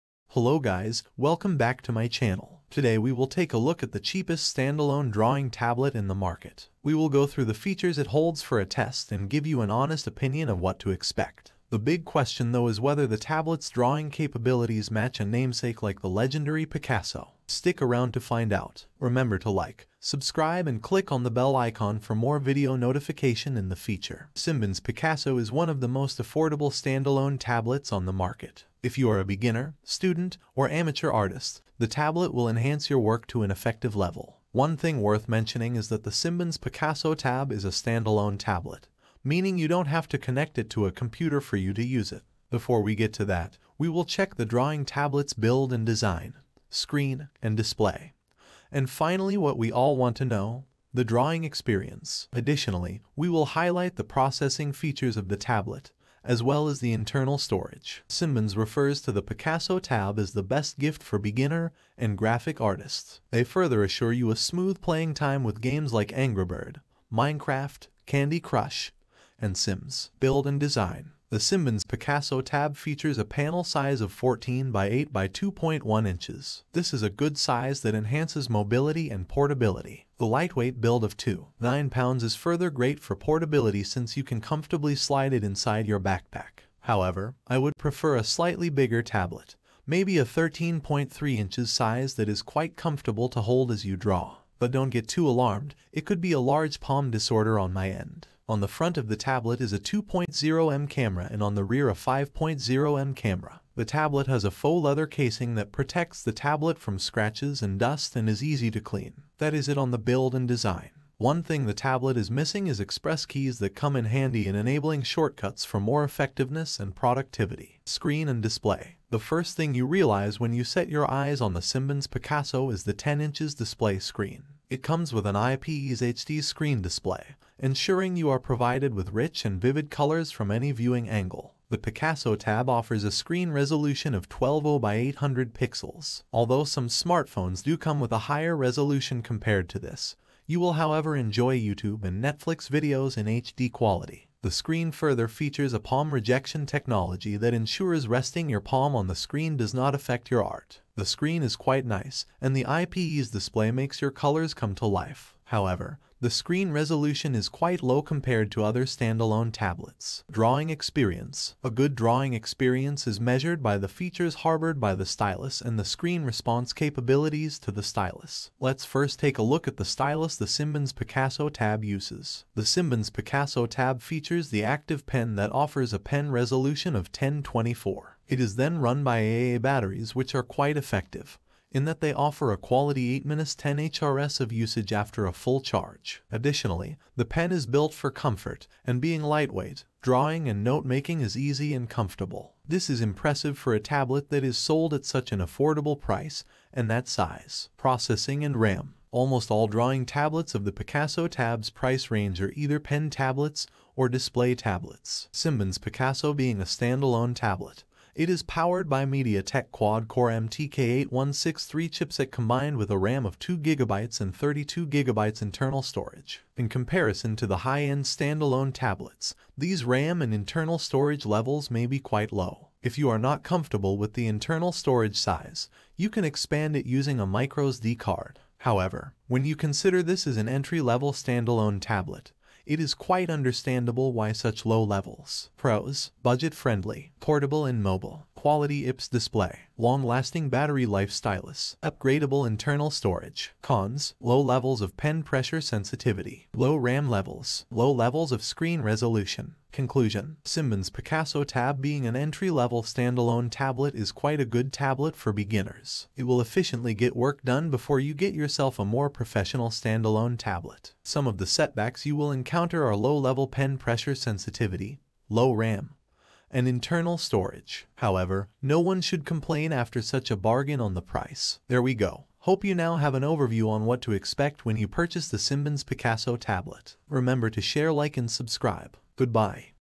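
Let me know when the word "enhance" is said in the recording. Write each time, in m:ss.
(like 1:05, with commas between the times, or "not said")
0:32, 1:17.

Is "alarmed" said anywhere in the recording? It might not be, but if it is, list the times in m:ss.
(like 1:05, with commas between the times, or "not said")
1:35.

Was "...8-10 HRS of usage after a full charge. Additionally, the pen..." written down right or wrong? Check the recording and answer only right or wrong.
right.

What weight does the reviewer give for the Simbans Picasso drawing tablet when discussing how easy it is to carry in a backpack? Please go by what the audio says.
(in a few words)
2.9 pounds.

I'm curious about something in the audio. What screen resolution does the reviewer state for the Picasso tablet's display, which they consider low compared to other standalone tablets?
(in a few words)
1200 by 800 pixels.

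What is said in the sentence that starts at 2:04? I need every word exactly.
It comes with an IPS HD screen display, ensuring you are provided with rich and vivid colors from any viewing angle.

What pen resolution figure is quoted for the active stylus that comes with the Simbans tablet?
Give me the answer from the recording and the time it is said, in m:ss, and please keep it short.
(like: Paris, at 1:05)
1024, at 2:57.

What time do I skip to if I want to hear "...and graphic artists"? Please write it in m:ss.
1:01.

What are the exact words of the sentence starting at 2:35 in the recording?
However, the screen resolution is quite low compared to other standalone tablets.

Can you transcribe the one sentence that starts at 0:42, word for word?
Before we get to that, we will check the drawing tablet's build and design screen, and display.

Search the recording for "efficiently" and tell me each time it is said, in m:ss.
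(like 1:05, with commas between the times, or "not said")
4:16.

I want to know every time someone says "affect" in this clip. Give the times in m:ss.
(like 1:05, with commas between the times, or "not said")
2:29.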